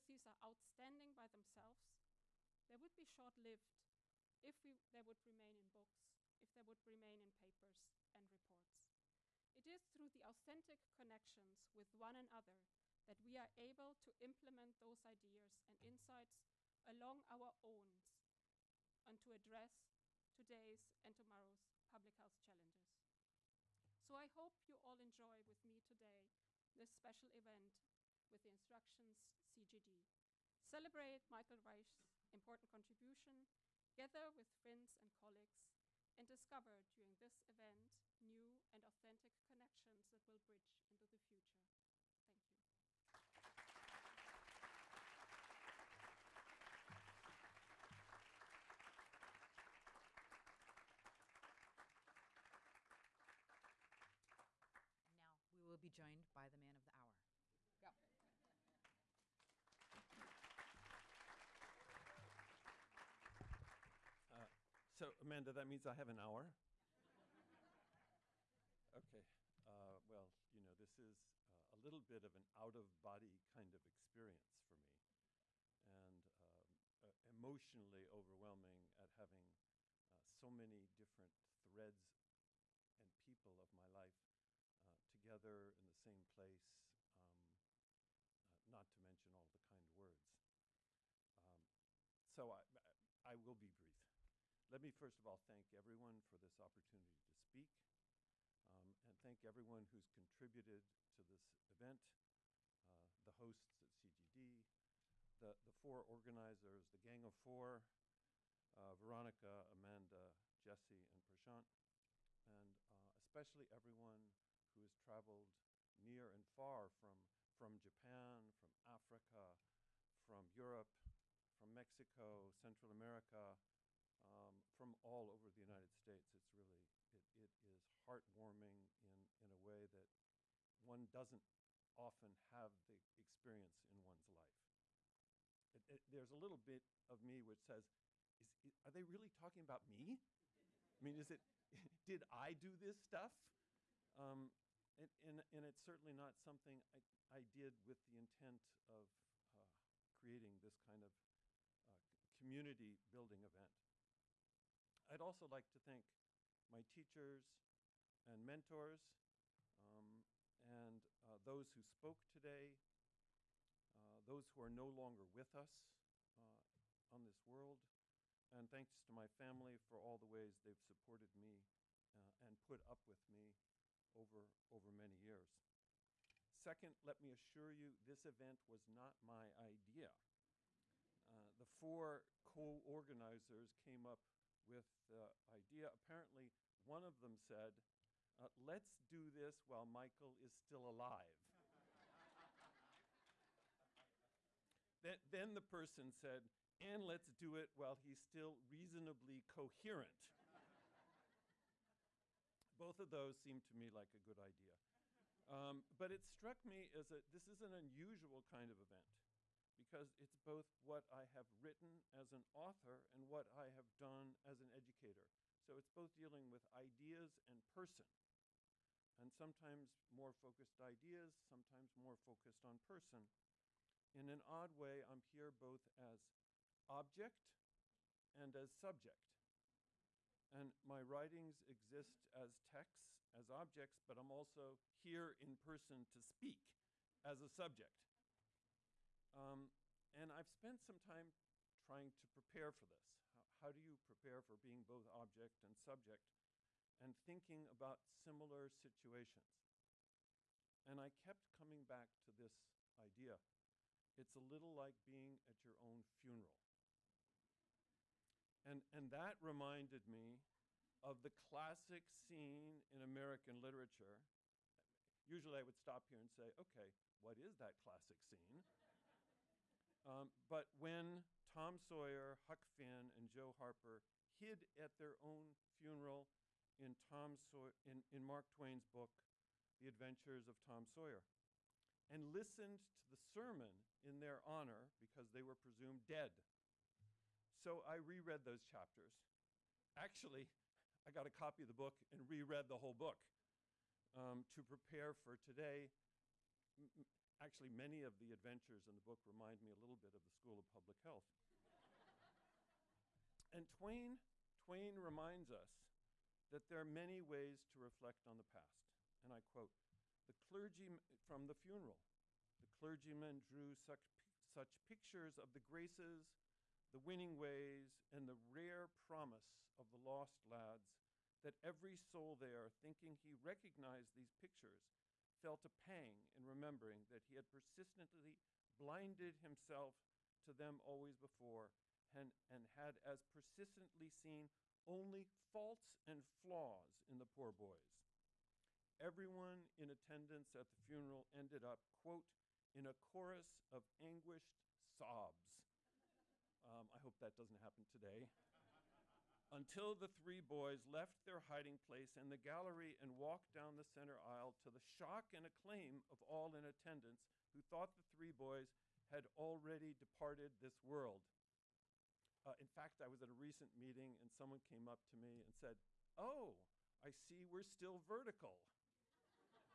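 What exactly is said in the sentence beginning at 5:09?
And I quote, the clergy from the funeral.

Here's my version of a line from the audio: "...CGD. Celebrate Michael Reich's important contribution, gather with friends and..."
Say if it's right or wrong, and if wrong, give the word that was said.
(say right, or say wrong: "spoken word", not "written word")
right.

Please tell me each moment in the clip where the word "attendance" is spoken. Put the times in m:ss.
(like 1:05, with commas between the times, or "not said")
5:39, 5:56.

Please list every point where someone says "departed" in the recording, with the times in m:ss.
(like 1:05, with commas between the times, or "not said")
5:59.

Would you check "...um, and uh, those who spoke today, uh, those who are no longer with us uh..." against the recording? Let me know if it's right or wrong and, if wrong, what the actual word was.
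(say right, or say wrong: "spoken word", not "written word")
right.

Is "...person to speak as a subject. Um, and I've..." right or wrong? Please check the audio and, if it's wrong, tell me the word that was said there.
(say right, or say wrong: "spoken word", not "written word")
right.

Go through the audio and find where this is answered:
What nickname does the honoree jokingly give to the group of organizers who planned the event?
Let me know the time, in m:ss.
1:46.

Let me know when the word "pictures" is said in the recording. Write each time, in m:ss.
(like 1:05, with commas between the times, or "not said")
5:14, 5:24.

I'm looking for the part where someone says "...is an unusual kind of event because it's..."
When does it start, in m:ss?
3:27.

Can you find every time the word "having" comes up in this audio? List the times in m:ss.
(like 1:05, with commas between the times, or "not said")
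1:19.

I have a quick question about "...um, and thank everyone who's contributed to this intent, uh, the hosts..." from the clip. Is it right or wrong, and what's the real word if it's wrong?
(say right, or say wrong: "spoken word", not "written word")
wrong: "event", not "intent".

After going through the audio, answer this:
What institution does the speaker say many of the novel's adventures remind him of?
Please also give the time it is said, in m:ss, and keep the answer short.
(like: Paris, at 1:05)
School of Public Health, at 5:00.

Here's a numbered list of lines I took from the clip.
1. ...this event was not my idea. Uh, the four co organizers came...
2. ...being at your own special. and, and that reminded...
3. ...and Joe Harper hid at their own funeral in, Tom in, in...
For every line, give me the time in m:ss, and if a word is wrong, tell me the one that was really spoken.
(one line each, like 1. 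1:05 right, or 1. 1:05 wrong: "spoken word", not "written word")
1. 2:58 right
2. 4:15 wrong: "funeral", not "special"
3. 4:33 right.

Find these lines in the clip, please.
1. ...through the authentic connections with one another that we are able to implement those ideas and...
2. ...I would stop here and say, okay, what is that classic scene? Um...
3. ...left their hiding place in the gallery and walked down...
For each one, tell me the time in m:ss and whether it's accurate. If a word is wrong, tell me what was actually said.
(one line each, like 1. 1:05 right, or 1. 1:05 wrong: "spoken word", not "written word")
1. 0:09 right
2. 4:25 right
3. 5:50 right.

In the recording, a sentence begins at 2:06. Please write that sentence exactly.
It's really, it, it is heartwarming in, in a way that one doesn't often have the experience in one's life.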